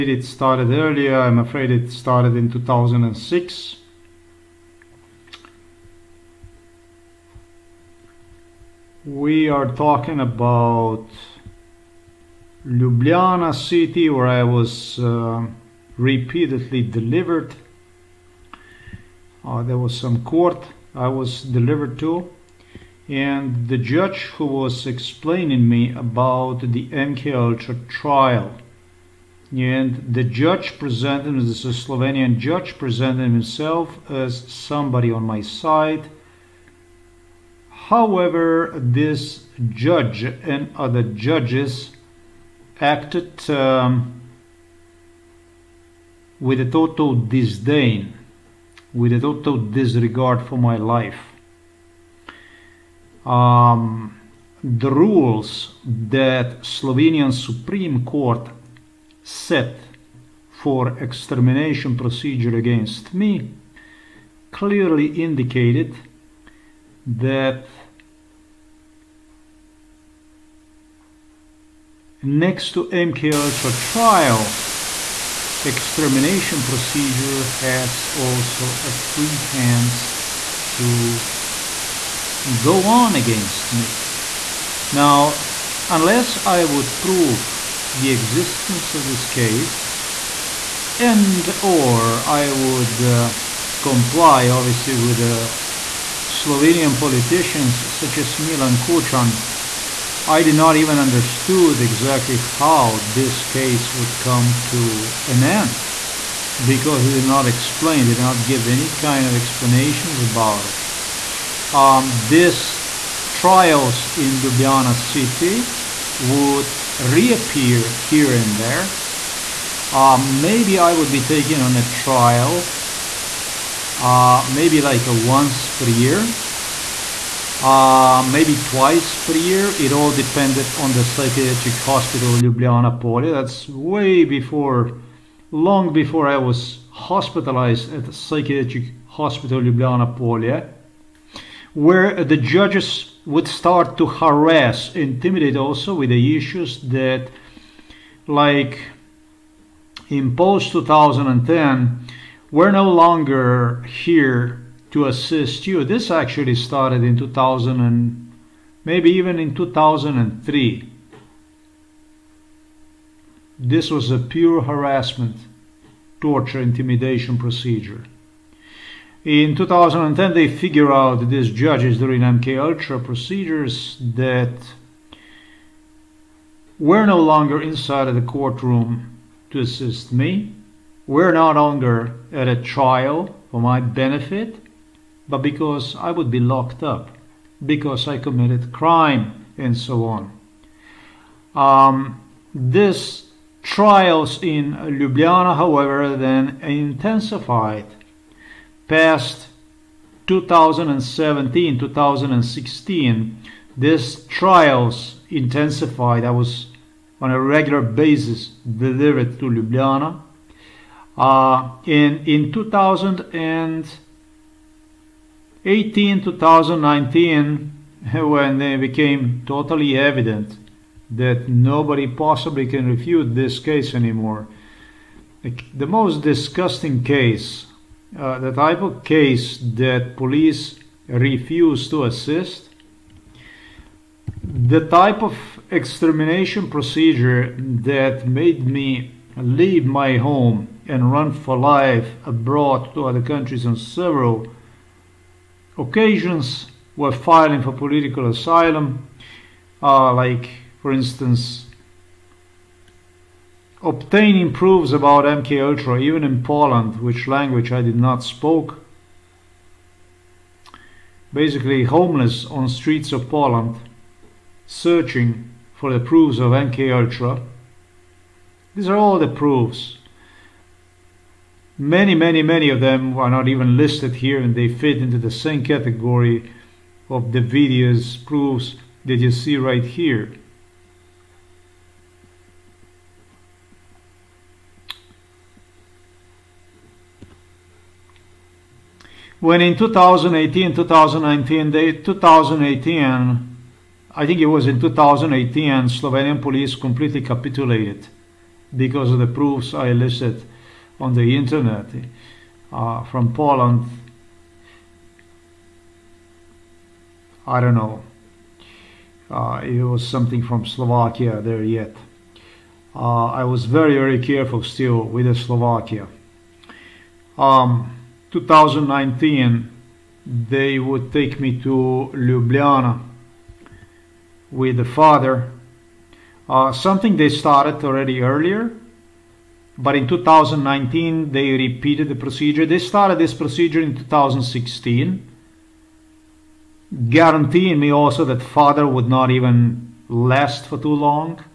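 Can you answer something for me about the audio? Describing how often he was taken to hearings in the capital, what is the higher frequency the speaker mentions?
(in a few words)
twice per year.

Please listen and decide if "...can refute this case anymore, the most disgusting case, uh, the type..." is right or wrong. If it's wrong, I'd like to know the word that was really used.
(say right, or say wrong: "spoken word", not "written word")
right.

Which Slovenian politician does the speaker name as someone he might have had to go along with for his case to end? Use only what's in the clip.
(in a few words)
Milan Kucan.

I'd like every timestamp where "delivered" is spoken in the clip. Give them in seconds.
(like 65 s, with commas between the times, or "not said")
16 s, 21 s, 208 s.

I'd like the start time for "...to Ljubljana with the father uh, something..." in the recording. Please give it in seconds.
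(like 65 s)
321 s.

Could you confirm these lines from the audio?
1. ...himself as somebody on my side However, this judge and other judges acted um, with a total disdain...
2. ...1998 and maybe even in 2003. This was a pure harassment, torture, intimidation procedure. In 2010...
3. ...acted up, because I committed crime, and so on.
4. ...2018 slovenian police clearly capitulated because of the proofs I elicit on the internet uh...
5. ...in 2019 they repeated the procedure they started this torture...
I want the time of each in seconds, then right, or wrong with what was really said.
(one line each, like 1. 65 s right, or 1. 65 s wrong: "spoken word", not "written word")
1. 33 s right
2. 157 s wrong: "2000", not "1998"
3. 186 s wrong: "locked", not "acted"
4. 294 s wrong: "completely", not "clearly"
5. 329 s wrong: "procedure", not "torture".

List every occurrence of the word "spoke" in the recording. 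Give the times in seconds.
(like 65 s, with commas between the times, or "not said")
258 s.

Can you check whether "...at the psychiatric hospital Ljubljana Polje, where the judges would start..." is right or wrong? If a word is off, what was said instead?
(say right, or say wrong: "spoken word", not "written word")
right.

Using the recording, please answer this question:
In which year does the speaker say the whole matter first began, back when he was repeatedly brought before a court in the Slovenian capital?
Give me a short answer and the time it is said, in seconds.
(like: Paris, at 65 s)
2006, at 2 s.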